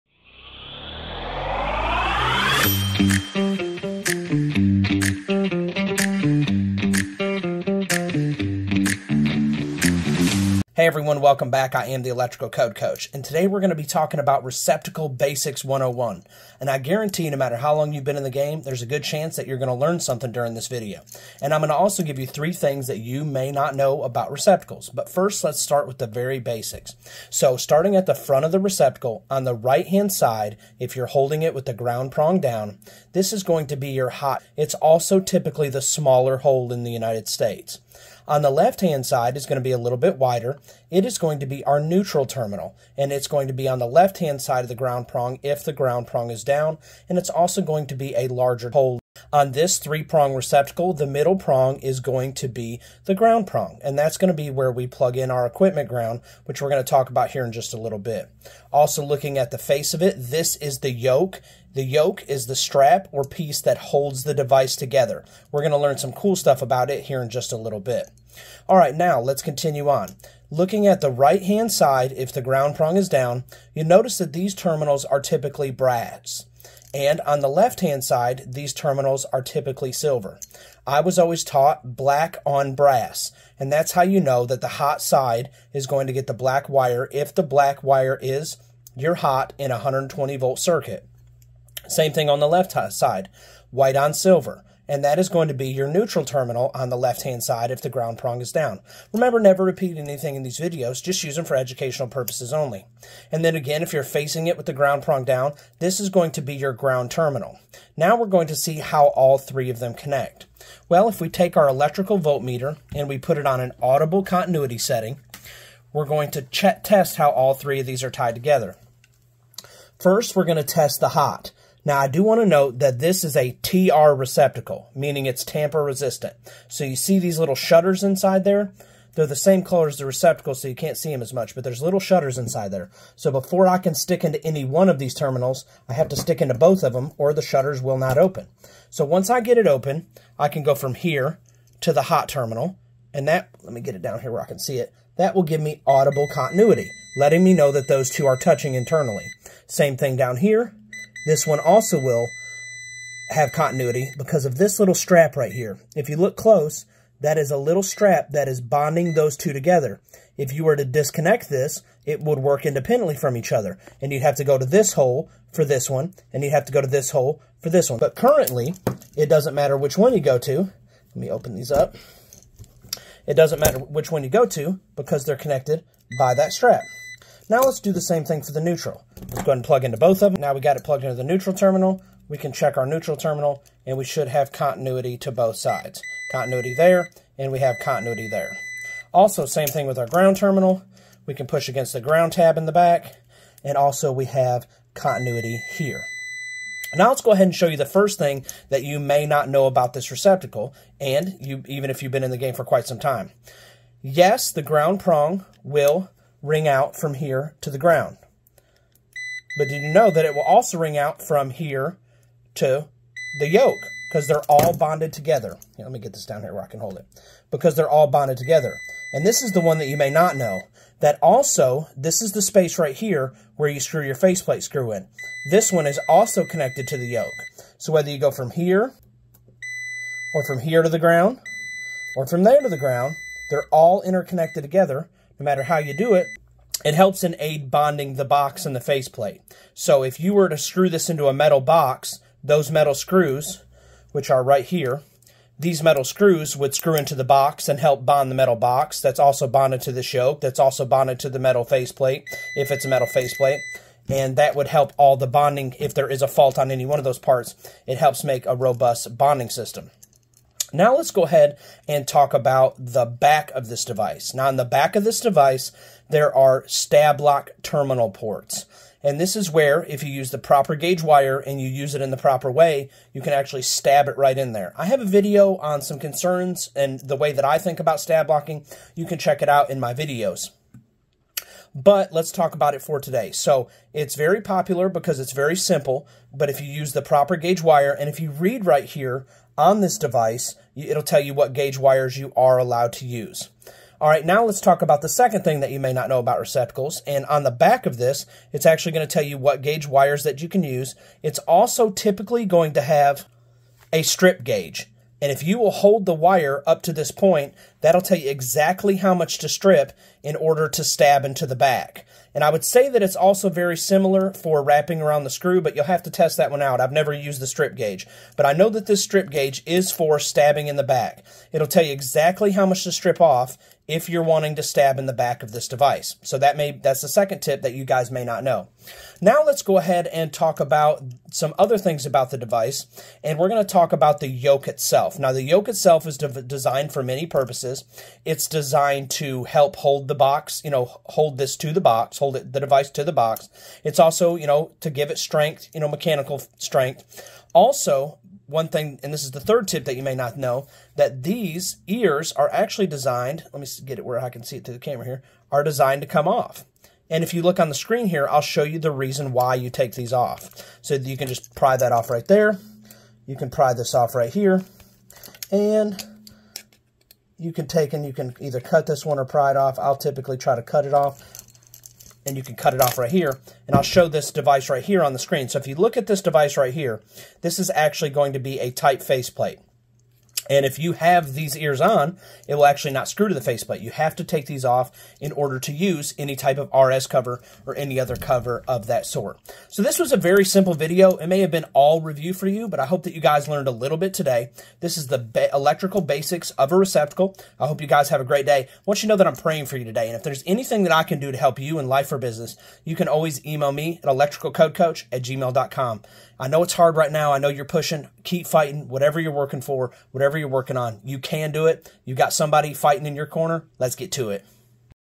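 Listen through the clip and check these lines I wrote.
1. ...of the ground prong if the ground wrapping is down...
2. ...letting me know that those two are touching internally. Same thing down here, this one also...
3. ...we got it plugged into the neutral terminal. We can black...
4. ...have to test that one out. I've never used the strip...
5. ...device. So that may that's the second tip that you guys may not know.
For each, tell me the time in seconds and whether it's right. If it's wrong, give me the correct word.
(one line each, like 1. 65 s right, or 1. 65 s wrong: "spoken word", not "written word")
1. 44 s wrong: "prong", not "wrapping"
2. 147 s right
3. 180 s wrong: "check", not "black"
4. 315 s right
5. 325 s right.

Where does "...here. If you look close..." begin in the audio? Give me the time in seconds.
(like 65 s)
155 s.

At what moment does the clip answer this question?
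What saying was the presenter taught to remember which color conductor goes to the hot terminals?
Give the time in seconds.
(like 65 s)
81 s.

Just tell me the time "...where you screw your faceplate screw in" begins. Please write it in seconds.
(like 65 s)
223 s.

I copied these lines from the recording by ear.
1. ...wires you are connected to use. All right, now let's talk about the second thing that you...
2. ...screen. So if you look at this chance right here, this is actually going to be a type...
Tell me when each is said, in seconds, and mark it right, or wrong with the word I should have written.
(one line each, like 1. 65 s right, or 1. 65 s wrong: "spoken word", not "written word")
1. 291 s wrong: "allowed", not "connected"
2. 375 s wrong: "device", not "chance".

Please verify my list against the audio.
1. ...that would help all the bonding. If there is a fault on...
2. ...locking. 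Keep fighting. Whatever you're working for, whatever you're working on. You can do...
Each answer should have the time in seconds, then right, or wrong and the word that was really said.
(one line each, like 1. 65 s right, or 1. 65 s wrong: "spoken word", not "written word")
1. 254 s right
2. 407 s wrong: "pushing", not "locking".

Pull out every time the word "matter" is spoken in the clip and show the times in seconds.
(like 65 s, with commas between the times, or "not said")
17 s, 169 s, 173 s, 235 s.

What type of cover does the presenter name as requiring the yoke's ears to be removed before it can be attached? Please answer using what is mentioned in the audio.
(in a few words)
RS cover.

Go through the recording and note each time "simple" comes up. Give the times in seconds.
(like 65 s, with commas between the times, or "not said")
285 s, 390 s.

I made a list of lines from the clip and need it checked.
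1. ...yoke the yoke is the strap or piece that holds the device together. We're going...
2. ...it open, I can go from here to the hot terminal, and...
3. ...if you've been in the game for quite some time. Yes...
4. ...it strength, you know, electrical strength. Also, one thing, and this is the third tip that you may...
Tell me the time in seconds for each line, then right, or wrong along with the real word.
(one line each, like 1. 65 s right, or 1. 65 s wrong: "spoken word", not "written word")
1. 60 s right
2. 139 s right
3. 201 s right
4. 345 s wrong: "mechanical", not "electrical".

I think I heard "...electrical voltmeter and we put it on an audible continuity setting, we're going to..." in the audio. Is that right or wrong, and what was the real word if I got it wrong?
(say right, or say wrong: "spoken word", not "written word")
right.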